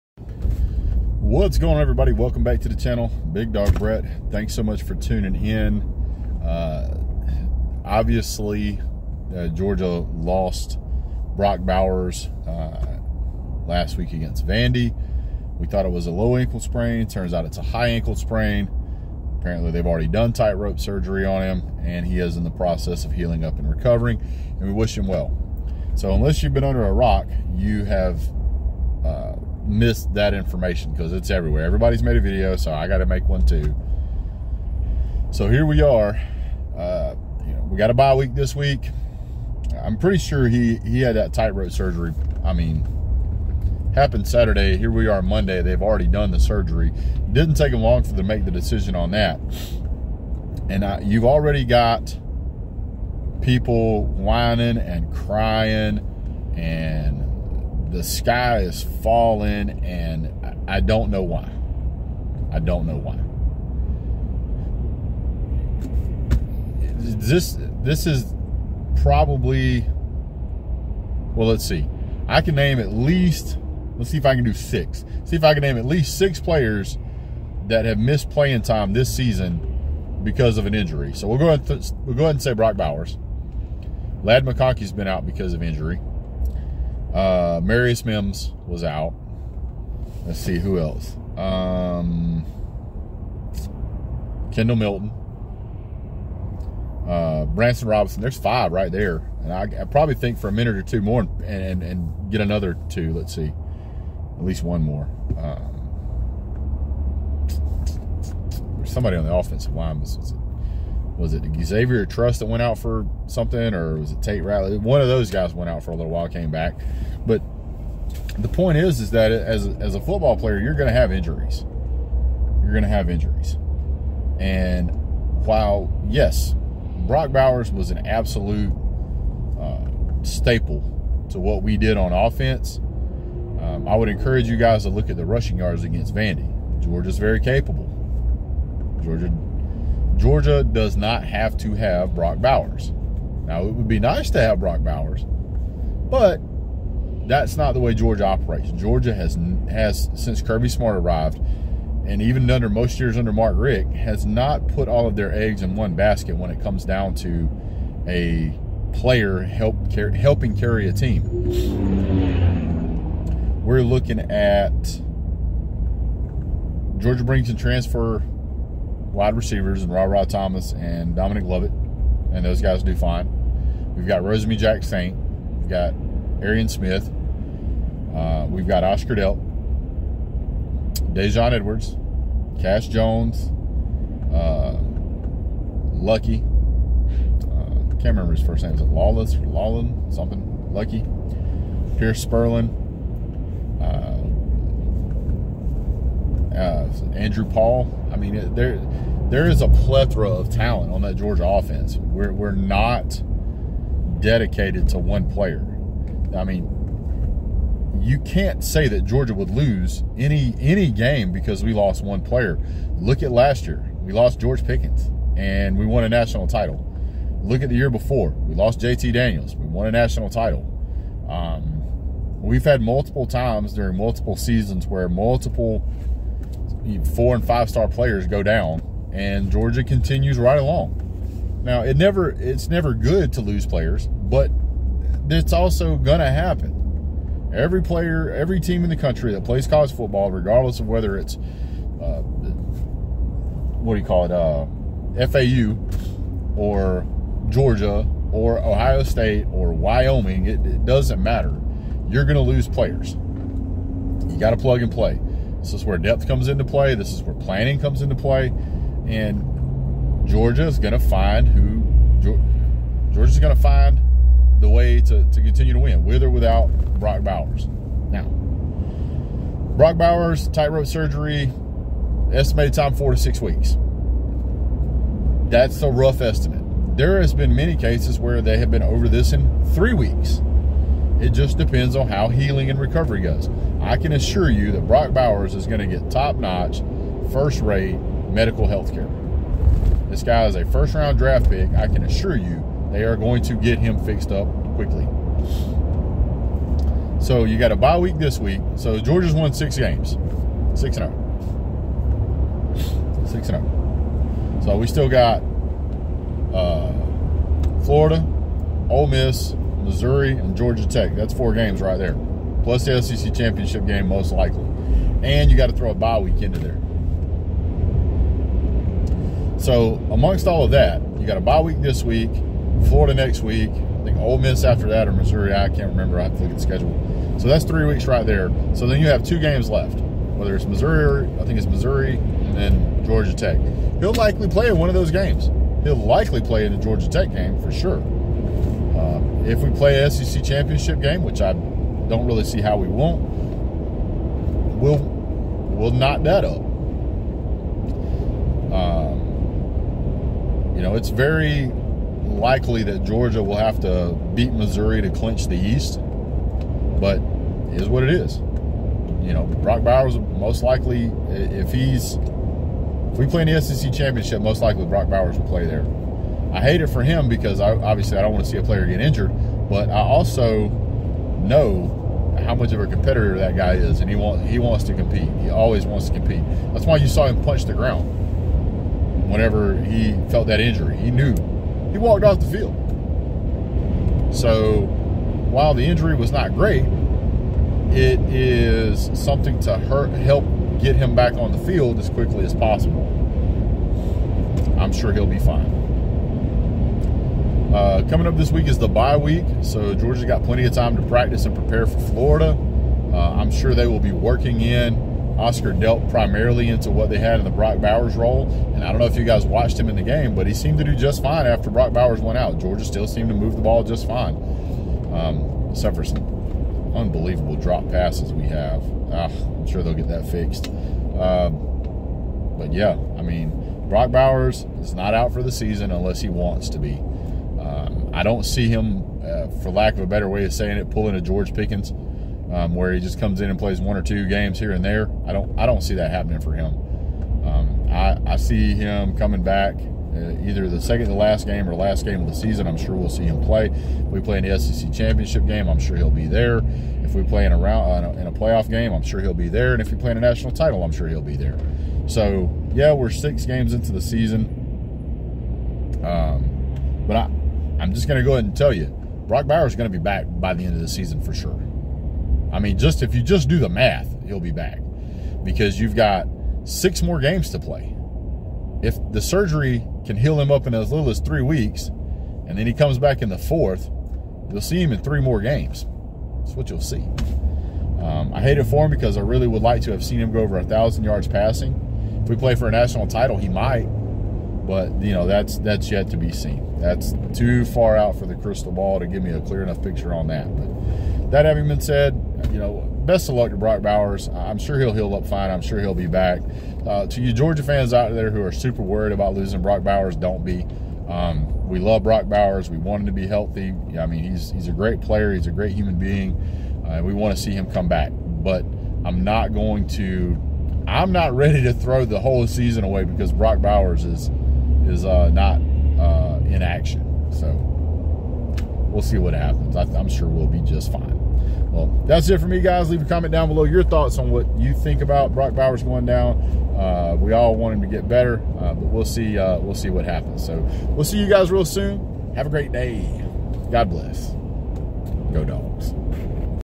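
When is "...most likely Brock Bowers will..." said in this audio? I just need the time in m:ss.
6:04.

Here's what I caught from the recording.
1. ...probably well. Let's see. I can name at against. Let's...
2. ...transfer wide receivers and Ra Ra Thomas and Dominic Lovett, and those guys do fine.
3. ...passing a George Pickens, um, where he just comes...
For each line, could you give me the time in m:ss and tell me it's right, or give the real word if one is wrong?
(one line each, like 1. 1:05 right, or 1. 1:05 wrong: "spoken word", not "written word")
1. 1:09 wrong: "least", not "against"
2. 2:47 right
3. 7:10 wrong: "pulling", not "passing".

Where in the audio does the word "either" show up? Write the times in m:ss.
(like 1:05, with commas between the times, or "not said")
7:20.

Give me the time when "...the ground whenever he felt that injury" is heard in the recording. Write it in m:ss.
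6:17.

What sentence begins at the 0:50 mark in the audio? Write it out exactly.
And I, you've already got people whining and crying and the sky is falling, and I don't know why.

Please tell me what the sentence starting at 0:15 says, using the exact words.
We thought it was a low ankle sprain.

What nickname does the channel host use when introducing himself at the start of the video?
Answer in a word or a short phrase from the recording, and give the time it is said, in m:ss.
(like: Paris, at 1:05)
Big Dog Brett, at 0:03.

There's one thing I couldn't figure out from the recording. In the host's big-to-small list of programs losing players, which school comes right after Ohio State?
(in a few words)
Wyoming.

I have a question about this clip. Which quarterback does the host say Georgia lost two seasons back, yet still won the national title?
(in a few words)
JT Daniels.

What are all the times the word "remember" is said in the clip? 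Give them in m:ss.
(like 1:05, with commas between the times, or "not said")
3:08, 5:25.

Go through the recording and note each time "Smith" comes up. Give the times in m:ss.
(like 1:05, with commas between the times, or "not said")
2:56.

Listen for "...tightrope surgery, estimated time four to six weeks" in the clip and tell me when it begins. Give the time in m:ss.
4:30.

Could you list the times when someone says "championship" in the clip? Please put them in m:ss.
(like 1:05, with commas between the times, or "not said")
5:13, 5:40, 6:03, 7:24.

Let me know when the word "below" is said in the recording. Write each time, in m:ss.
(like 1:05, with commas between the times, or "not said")
8:43.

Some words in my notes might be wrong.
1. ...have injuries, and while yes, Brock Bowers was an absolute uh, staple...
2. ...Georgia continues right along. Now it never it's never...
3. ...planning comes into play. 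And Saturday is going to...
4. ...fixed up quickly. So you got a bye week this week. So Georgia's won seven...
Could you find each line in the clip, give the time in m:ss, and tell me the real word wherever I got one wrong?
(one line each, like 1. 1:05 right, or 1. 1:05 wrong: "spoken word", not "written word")
1. 2:02 right
2. 3:49 right
3. 4:17 wrong: "Georgia", not "Saturday"
4. 4:54 wrong: "six", not "seven".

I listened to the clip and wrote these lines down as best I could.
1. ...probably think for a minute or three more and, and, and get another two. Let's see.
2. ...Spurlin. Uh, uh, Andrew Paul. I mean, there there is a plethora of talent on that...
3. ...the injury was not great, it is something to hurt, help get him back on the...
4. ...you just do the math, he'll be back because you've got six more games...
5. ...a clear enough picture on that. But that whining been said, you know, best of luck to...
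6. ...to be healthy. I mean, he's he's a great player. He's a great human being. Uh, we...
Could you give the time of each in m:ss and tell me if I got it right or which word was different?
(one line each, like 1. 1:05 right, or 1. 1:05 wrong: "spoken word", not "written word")
1. 1:39 wrong: "two", not "three"
2. 3:12 right
3. 6:25 right
4. 7:43 right
5. 8:09 wrong: "having", not "whining"
6. 8:23 right.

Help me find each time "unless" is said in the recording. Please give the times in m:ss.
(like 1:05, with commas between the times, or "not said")
0:26, 7:05.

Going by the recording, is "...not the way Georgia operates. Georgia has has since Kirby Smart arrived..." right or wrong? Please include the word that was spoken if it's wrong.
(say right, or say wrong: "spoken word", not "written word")
right.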